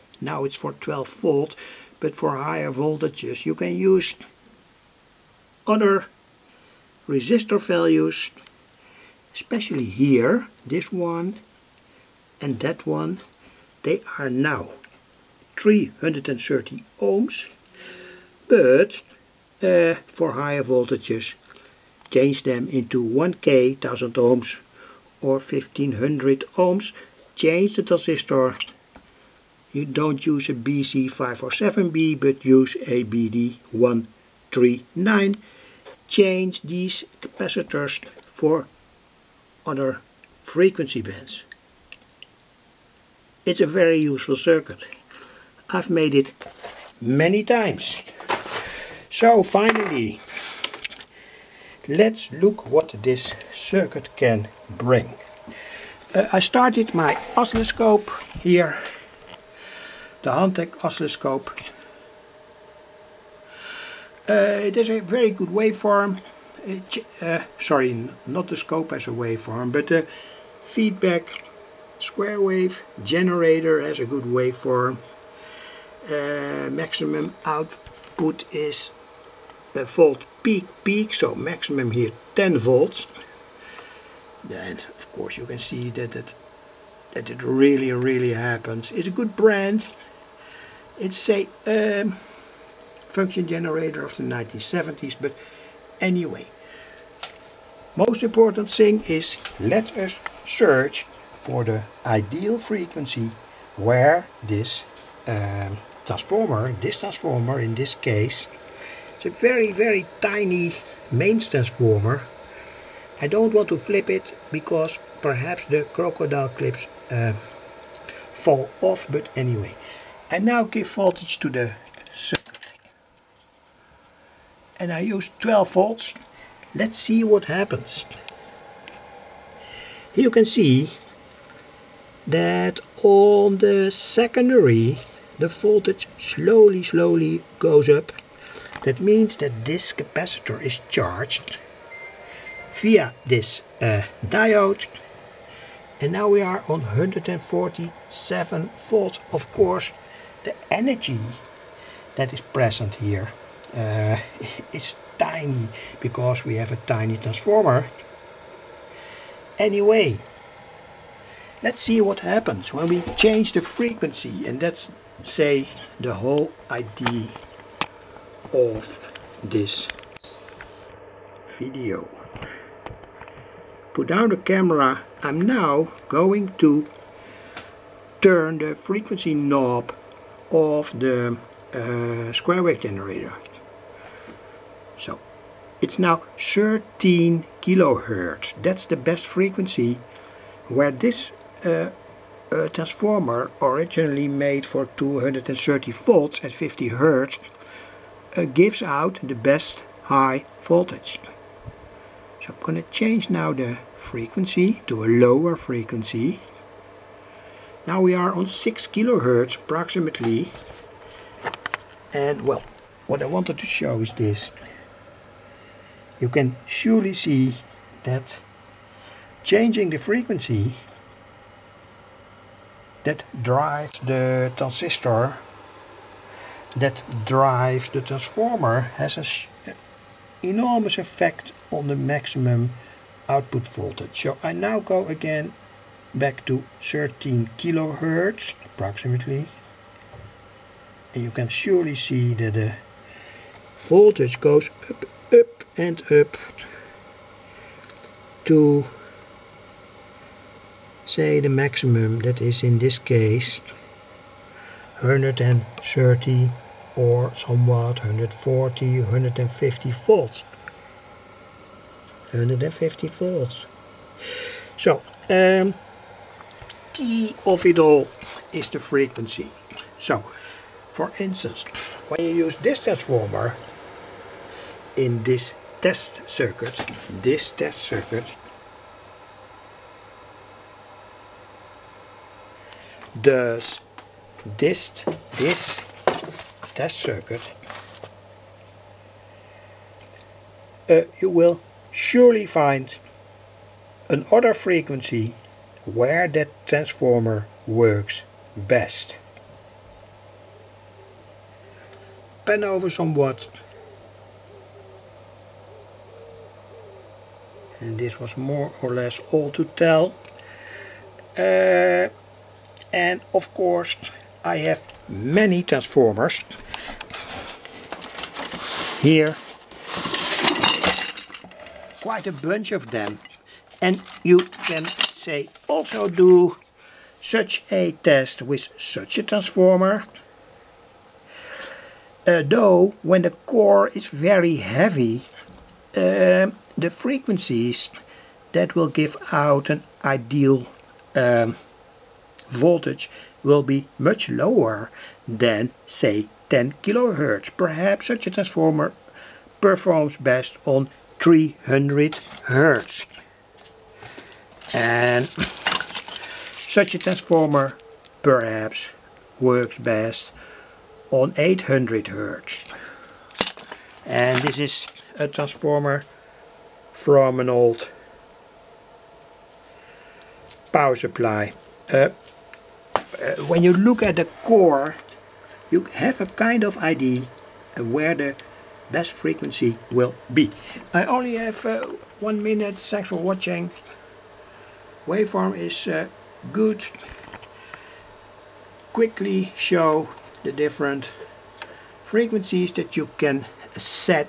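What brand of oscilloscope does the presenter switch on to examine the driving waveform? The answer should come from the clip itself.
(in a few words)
Hantek.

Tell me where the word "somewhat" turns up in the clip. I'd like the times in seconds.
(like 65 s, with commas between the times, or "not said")
257 s, 302 s.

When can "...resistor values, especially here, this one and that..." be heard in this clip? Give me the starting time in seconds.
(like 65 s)
7 s.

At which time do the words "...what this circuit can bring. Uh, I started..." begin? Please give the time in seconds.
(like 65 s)
52 s.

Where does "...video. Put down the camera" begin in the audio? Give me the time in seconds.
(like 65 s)
171 s.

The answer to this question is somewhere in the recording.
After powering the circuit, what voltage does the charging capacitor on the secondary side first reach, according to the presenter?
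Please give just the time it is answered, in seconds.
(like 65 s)
146 s.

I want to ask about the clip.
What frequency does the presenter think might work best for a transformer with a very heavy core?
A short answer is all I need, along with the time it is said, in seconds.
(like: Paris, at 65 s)
300 hertz, at 351 s.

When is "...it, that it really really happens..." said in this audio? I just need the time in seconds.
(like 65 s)
86 s.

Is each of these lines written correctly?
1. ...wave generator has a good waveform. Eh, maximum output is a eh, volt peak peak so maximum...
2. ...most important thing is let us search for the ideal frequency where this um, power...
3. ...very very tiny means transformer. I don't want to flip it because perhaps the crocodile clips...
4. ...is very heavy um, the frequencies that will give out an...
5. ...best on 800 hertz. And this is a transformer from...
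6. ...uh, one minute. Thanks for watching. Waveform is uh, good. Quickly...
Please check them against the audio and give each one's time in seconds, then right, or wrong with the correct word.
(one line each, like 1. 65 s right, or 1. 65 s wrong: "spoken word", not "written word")
1. 72 s right
2. 97 s wrong: "transformer", not "power"
3. 109 s wrong: "mains", not "means"
4. 333 s right
5. 359 s right
6. 381 s right.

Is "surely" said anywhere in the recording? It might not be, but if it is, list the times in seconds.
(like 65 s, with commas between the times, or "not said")
216 s, 241 s, 291 s.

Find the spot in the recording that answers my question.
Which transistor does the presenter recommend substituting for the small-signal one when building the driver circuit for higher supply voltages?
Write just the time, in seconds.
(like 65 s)
33 s.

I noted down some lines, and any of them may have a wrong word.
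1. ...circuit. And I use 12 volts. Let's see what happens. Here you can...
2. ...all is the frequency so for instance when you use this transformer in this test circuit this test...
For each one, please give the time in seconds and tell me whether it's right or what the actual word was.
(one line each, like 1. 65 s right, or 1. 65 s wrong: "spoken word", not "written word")
1. 122 s right
2. 267 s right.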